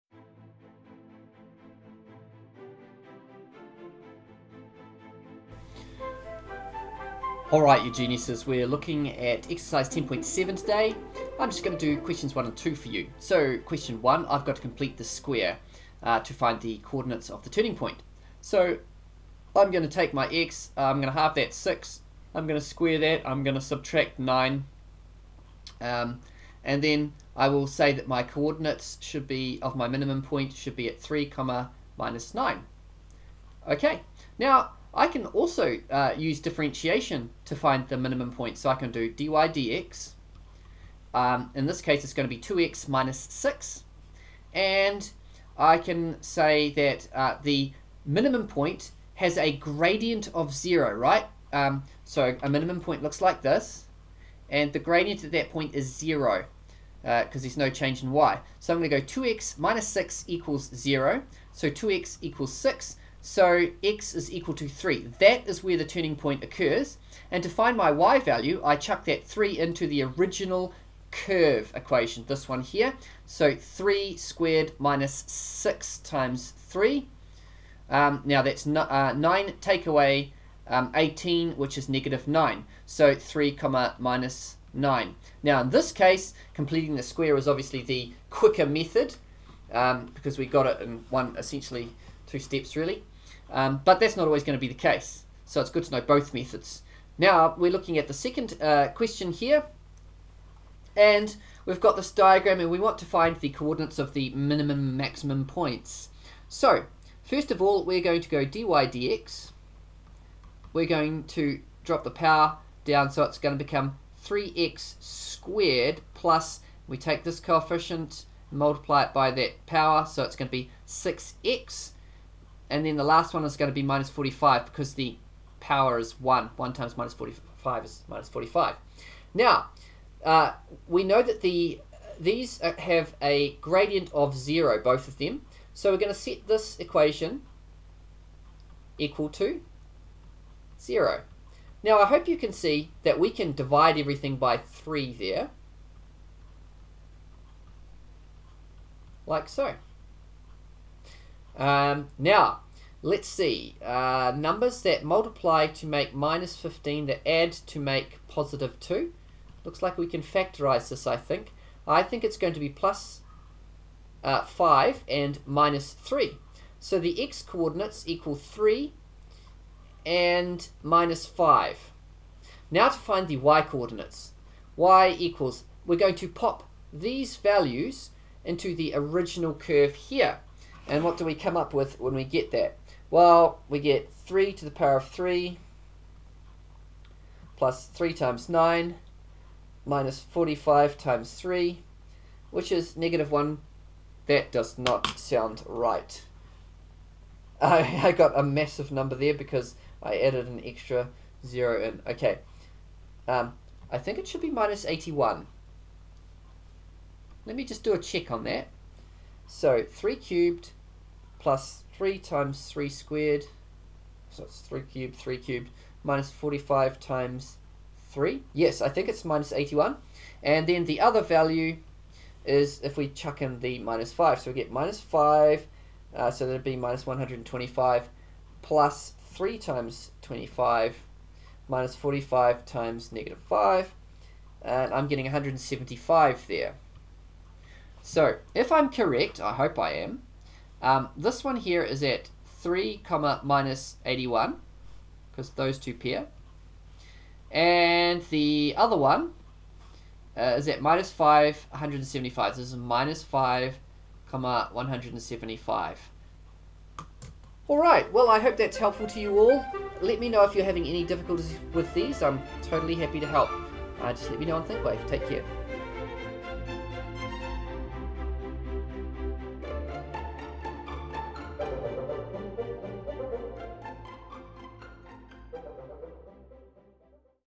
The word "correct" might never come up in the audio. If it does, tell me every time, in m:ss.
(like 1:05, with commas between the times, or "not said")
3:58.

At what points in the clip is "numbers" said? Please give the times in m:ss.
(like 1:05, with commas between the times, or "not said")
2:34, 3:18.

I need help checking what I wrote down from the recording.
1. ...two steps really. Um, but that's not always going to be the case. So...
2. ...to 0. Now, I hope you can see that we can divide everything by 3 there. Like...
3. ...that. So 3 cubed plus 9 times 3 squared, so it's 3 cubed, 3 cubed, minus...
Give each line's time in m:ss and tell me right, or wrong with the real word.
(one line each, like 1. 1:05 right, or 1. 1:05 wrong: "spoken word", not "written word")
1. 1:32 right
2. 2:19 right
3. 3:28 wrong: "3", not "9".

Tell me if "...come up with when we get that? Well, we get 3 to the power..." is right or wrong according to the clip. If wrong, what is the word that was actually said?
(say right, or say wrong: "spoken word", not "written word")
right.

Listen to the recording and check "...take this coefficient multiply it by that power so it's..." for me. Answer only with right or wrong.
right.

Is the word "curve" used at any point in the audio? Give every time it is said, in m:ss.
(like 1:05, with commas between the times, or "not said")
1:11, 2:59.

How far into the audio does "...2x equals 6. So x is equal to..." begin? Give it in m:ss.
1:01.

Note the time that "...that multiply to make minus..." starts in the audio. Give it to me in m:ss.
2:34.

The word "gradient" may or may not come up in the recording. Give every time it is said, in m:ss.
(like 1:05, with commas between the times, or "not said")
0:49, 0:54, 2:13.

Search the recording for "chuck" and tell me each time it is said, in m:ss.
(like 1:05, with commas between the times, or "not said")
1:08, 3:43.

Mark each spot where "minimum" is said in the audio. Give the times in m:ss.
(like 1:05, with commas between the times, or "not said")
0:29, 0:37, 0:48, 0:52, 1:44.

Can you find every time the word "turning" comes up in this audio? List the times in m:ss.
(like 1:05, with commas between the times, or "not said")
0:17, 1:05.